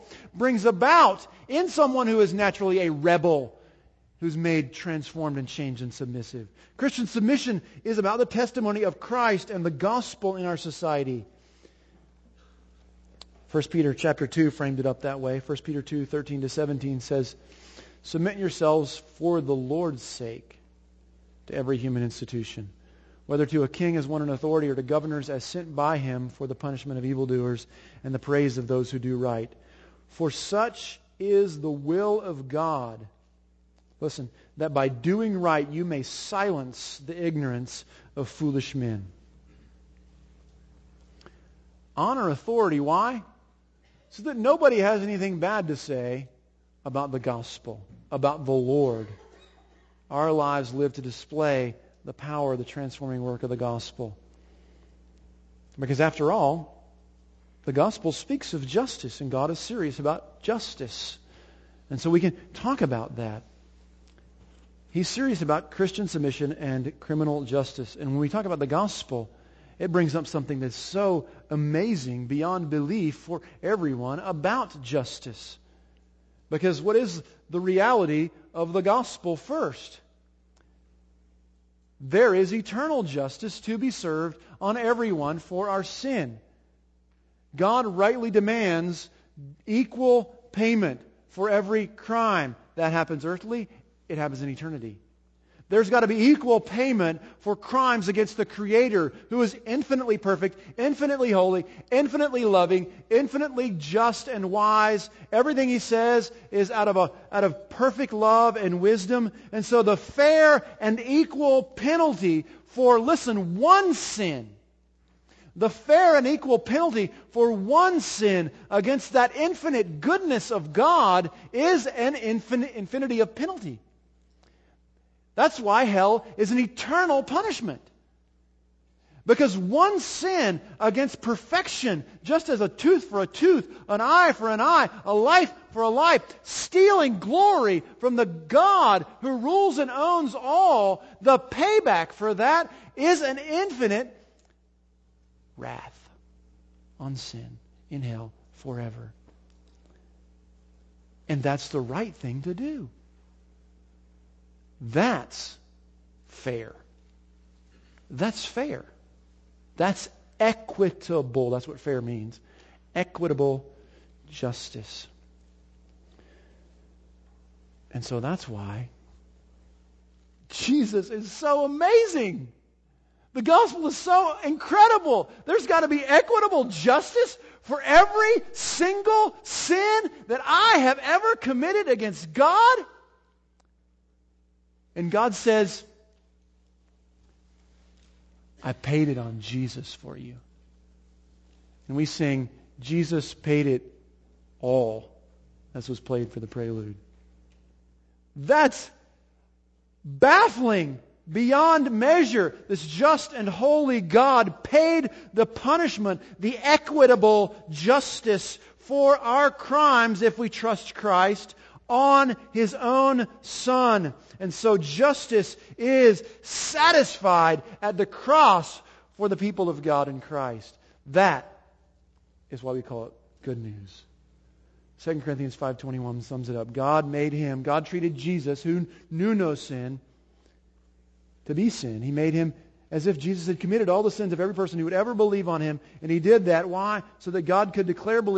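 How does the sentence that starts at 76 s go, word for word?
Because what is the reality of the gospel first?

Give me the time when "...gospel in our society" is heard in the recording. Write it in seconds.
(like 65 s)
9 s.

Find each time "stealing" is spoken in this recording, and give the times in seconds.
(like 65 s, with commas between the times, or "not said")
136 s.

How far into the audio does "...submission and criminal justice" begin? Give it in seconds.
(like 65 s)
66 s.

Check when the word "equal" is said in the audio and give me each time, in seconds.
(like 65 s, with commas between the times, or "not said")
89 s, 96 s, 110 s, 116 s.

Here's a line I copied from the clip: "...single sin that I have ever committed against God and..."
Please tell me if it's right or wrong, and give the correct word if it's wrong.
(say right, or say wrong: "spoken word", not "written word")
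right.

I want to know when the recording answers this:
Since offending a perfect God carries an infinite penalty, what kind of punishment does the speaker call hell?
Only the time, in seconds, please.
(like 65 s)
126 s.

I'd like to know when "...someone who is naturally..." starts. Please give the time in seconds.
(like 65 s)
1 s.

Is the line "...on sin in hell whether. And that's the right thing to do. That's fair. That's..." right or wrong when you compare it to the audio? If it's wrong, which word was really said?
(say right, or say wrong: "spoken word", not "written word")
wrong: "forever", not "whether".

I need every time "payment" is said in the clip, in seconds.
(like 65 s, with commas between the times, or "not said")
90 s, 96 s.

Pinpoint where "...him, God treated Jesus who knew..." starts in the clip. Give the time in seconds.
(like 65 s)
227 s.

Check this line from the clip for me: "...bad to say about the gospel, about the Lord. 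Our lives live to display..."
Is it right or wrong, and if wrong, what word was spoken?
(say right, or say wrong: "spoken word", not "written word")
right.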